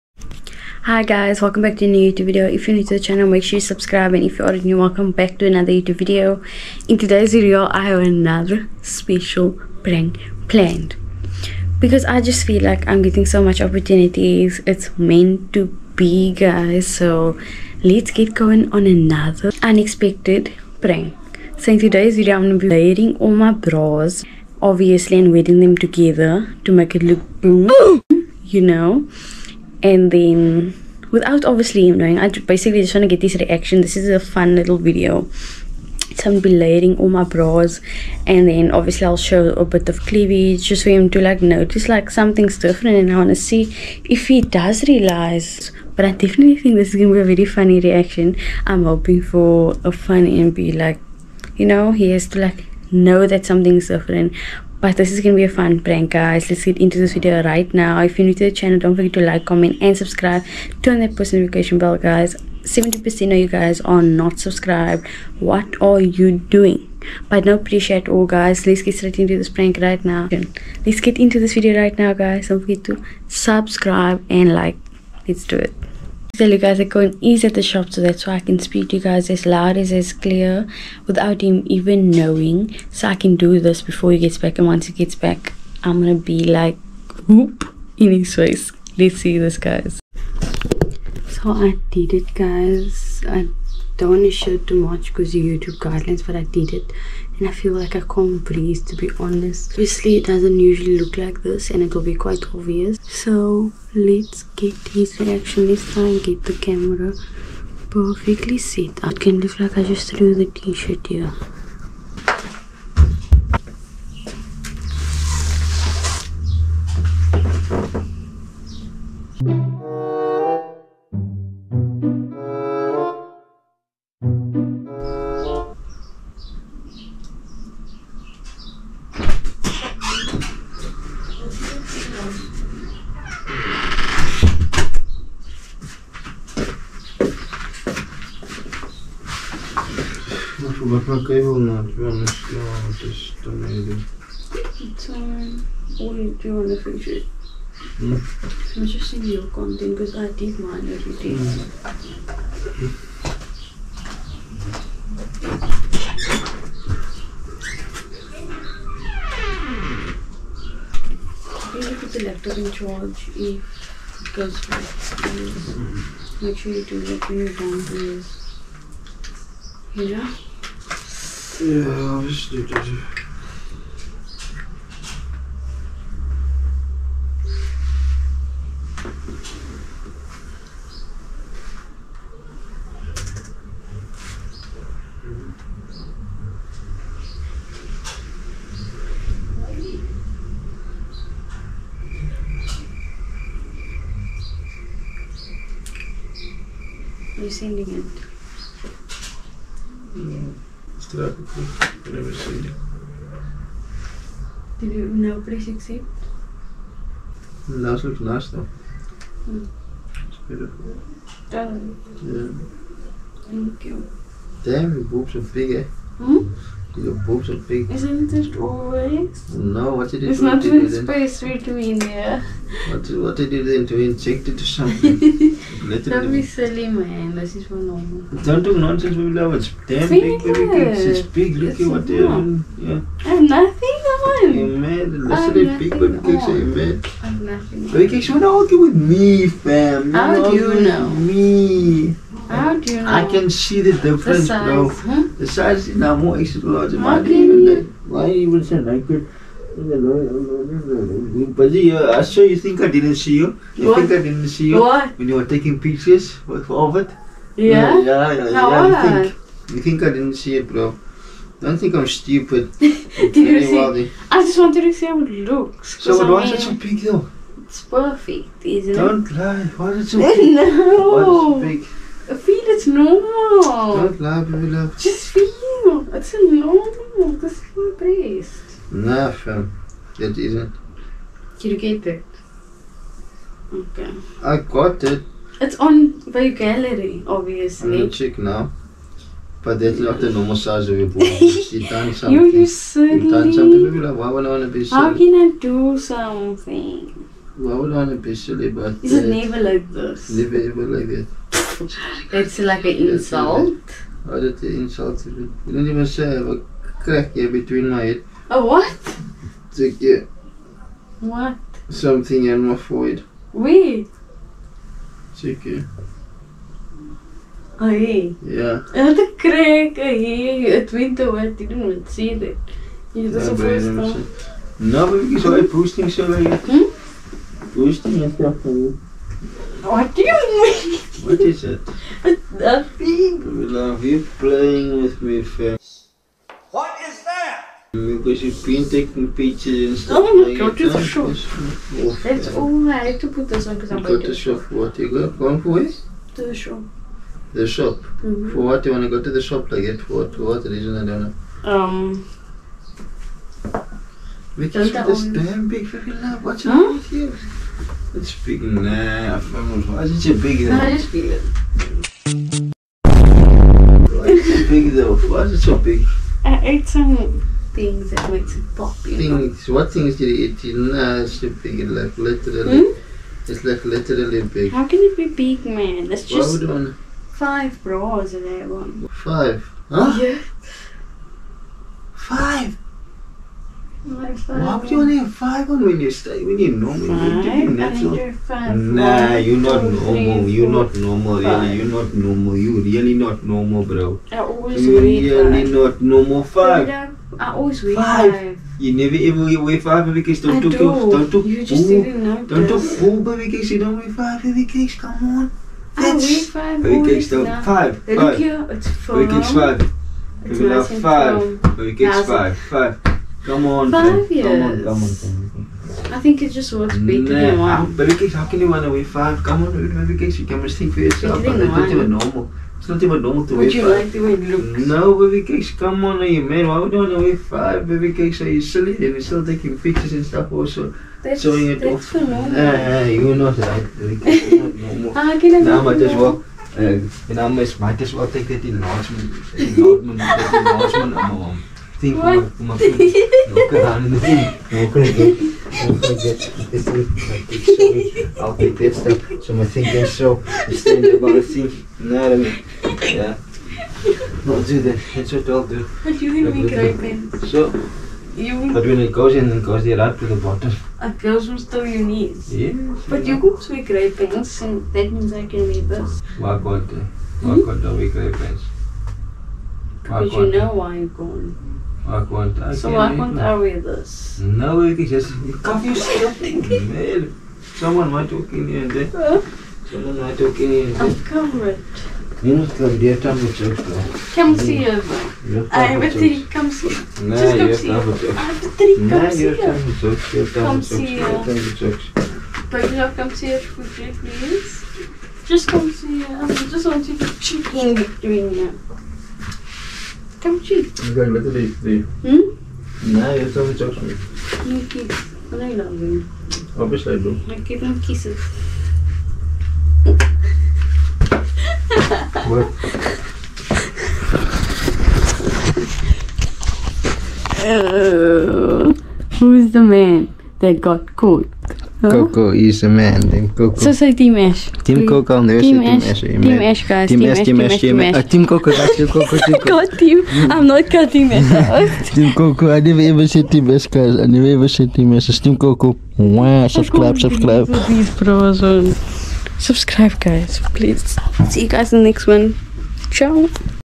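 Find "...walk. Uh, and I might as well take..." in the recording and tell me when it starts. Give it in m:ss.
7:16.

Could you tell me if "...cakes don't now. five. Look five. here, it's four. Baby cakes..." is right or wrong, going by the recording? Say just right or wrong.
right.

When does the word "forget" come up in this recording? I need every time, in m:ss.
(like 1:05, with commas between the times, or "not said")
0:58, 1:12.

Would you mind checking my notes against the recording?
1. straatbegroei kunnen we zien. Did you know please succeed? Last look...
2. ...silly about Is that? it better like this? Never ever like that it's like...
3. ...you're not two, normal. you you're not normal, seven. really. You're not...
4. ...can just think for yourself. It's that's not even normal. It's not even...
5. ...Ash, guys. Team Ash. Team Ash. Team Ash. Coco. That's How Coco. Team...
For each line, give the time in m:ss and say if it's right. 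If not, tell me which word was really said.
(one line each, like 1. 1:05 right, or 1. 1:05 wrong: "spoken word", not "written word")
1. 3:21 right
2. 4:58 wrong: "never", not "better"
3. 6:29 wrong: "five", not "seven"
4. 7:00 right
5. 8:46 wrong: "Team", not "How".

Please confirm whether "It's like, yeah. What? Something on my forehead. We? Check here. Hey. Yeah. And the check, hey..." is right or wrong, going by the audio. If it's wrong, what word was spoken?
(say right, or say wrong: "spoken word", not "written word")
wrong: "crack", not "check".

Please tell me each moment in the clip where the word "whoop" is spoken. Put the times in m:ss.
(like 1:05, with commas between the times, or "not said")
1:27.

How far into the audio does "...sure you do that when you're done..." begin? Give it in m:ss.
2:46.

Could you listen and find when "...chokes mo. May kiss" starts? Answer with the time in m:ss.
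8:23.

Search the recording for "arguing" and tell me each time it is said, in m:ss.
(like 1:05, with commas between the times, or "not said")
3:58.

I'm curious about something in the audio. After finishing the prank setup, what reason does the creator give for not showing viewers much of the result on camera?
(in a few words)
YouTube guidelines.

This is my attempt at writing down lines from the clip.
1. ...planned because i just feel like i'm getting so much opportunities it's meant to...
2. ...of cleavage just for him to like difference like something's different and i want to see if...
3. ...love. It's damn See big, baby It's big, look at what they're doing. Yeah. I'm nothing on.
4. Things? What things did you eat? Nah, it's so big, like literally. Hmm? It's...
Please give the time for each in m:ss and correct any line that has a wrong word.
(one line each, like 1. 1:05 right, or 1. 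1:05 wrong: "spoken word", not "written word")
1. 0:10 right
2. 0:39 wrong: "notice", not "difference"
3. 3:49 right
4. 6:08 right.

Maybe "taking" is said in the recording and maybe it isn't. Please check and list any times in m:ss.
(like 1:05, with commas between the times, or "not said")
4:15, 5:38, 7:09.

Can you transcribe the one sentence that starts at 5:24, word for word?
Nou, ik zou je posting so weer.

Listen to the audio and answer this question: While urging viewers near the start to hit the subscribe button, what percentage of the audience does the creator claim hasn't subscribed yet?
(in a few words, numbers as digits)
70%.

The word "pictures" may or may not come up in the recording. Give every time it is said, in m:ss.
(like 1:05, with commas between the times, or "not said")
4:15, 5:39, 7:09.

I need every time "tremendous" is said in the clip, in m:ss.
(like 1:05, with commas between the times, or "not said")
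not said.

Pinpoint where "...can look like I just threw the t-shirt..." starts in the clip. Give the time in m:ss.
1:49.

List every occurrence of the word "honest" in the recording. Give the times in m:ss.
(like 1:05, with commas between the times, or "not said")
1:39, 2:22.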